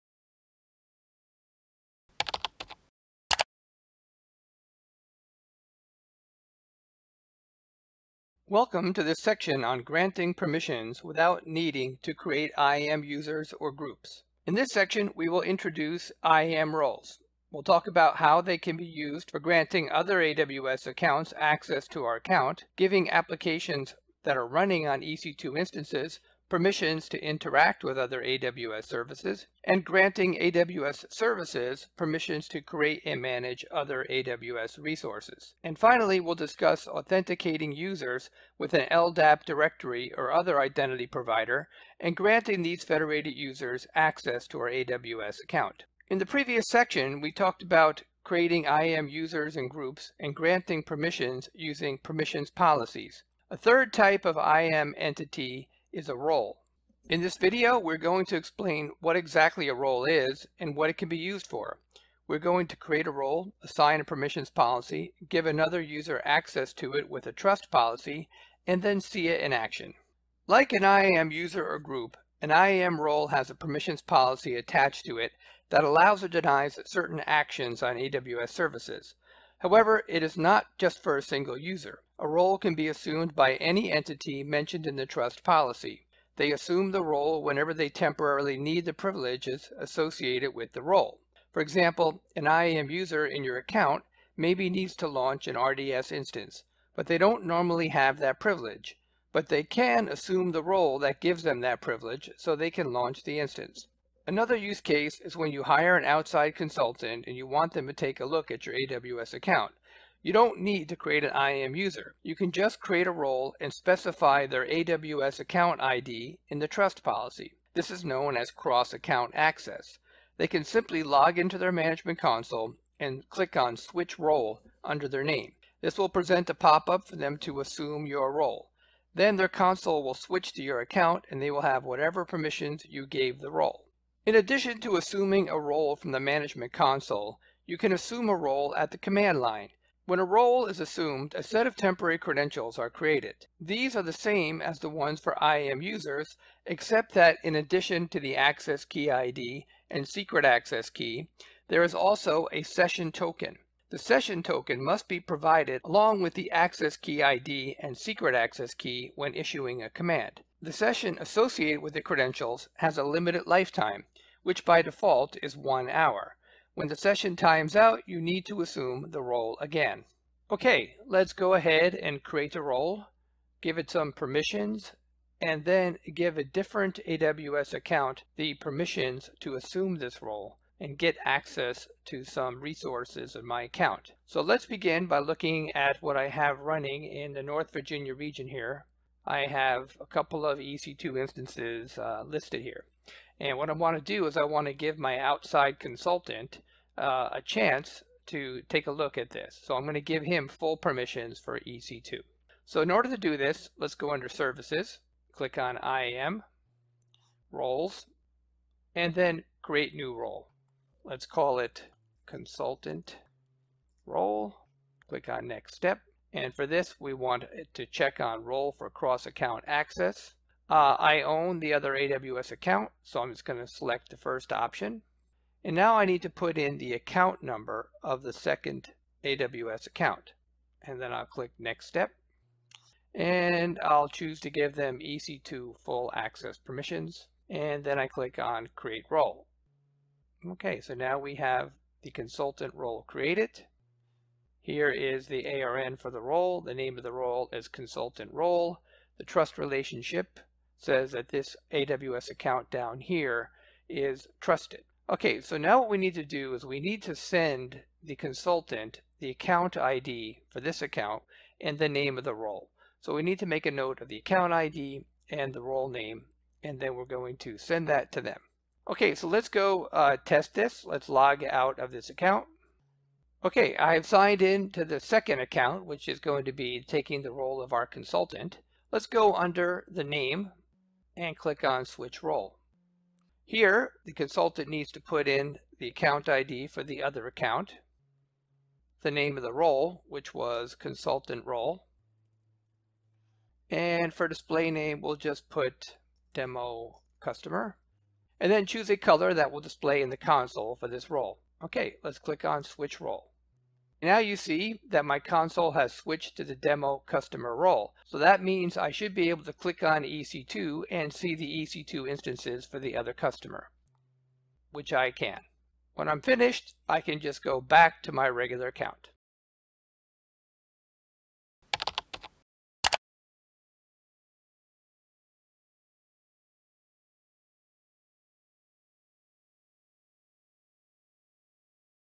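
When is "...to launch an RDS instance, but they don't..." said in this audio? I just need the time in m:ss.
1:34.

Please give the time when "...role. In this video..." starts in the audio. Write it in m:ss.
0:56.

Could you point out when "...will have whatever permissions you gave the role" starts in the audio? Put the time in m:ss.
2:11.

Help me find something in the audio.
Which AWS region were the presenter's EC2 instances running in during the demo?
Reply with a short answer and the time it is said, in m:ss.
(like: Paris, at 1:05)
North Virginia, at 3:07.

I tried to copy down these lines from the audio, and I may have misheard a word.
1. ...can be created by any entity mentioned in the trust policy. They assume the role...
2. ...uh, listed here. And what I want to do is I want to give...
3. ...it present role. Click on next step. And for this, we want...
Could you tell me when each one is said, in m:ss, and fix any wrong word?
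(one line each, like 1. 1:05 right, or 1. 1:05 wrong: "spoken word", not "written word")
1. 1:22 wrong: "assumed", not "created"
2. 3:11 right
3. 3:31 wrong: "consultant", not "present".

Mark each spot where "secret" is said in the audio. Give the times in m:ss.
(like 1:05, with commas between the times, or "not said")
2:30, 2:37.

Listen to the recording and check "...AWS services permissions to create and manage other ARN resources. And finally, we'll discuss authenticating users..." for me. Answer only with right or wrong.
wrong.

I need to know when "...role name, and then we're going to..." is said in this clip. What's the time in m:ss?
4:25.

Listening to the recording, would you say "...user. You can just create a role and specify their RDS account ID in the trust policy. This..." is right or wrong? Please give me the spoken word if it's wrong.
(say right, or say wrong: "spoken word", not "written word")
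wrong: "AWS", not "RDS".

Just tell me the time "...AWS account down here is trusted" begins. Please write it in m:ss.
4:11.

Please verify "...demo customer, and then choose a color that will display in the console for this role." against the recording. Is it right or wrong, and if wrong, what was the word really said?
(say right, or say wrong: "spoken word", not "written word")
right.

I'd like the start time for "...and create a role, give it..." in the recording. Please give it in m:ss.
2:51.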